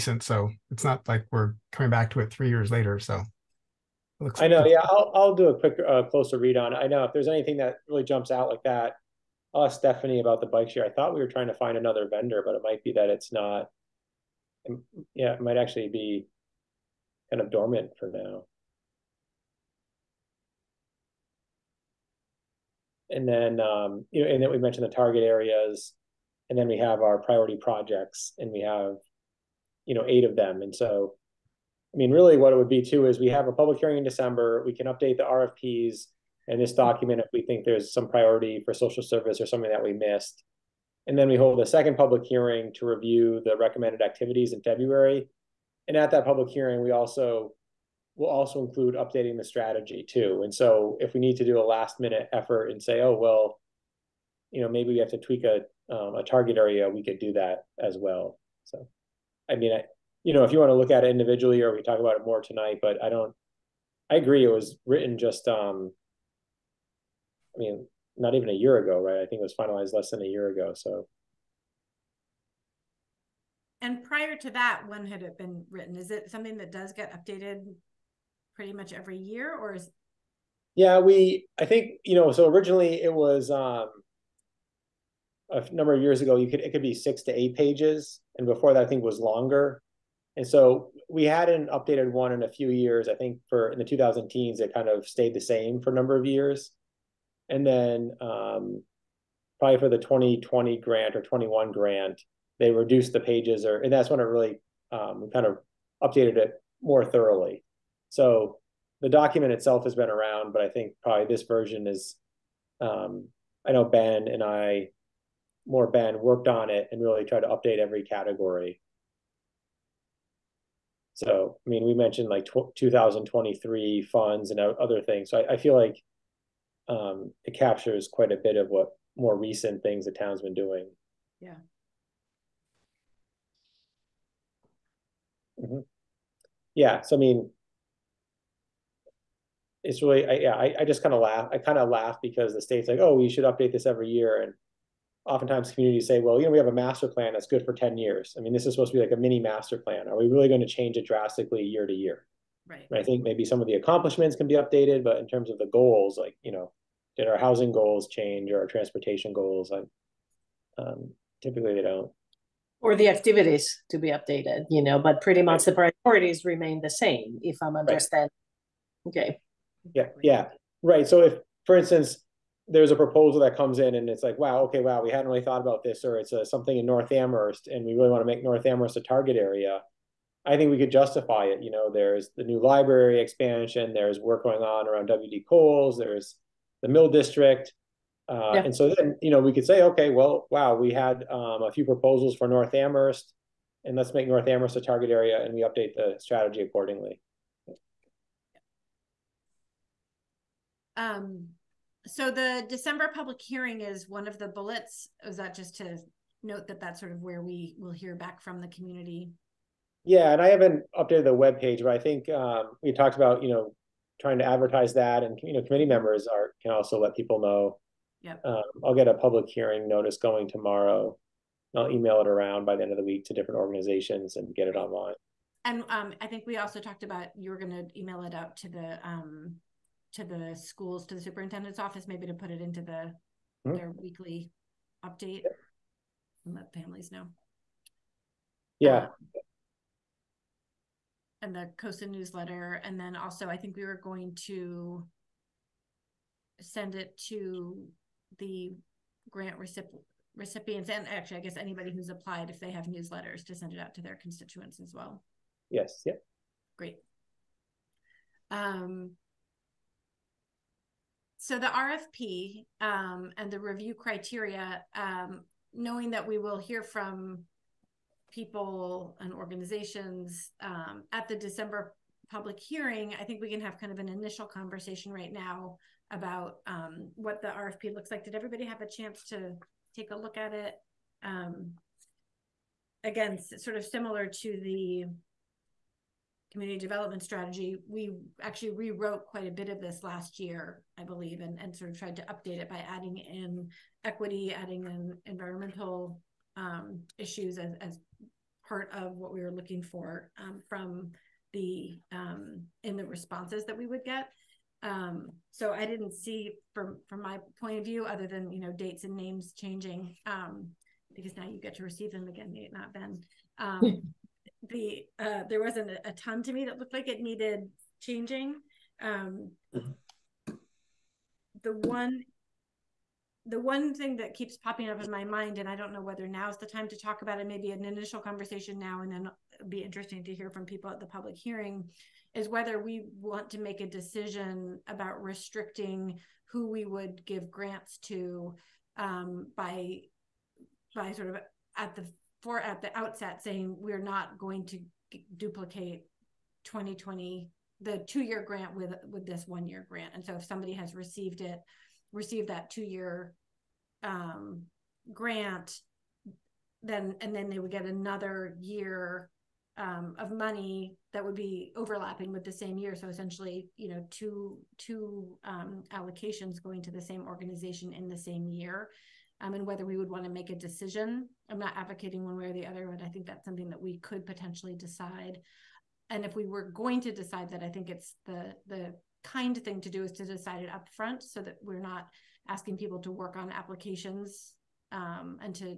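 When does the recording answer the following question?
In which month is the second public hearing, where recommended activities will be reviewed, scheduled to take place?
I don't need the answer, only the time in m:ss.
0:44.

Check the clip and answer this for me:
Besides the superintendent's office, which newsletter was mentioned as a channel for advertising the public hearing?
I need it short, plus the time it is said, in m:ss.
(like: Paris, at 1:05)
COSA newsletter, at 4:01.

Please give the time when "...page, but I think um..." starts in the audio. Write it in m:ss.
3:31.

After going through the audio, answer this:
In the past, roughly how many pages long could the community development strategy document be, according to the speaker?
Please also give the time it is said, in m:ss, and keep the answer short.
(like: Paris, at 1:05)
6 to 8 pages, at 1:26.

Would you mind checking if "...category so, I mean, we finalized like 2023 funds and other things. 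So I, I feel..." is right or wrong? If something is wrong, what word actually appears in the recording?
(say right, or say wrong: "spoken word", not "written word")
wrong: "mentioned", not "finalized".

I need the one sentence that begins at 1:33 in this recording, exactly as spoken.
I think for in the 2000 teens, it kind of stayed the same for a number of years.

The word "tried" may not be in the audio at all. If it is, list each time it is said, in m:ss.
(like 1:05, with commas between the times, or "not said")
1:57, 4:51.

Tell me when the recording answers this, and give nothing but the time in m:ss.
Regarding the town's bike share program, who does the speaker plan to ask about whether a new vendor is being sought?
0:09.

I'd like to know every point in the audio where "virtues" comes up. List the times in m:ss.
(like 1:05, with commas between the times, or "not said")
not said.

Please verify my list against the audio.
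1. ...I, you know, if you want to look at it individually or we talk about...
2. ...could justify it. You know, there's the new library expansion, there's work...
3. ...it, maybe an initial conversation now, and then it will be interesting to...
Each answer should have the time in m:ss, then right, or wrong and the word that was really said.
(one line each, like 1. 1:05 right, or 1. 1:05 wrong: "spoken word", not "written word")
1. 0:59 right
2. 3:00 right
3. 5:27 right.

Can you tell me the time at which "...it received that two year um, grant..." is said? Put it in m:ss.
5:51.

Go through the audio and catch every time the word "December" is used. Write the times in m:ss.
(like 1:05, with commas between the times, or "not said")
0:34, 3:22, 4:31.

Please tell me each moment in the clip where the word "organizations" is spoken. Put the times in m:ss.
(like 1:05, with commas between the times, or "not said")
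3:43, 4:29, 6:07.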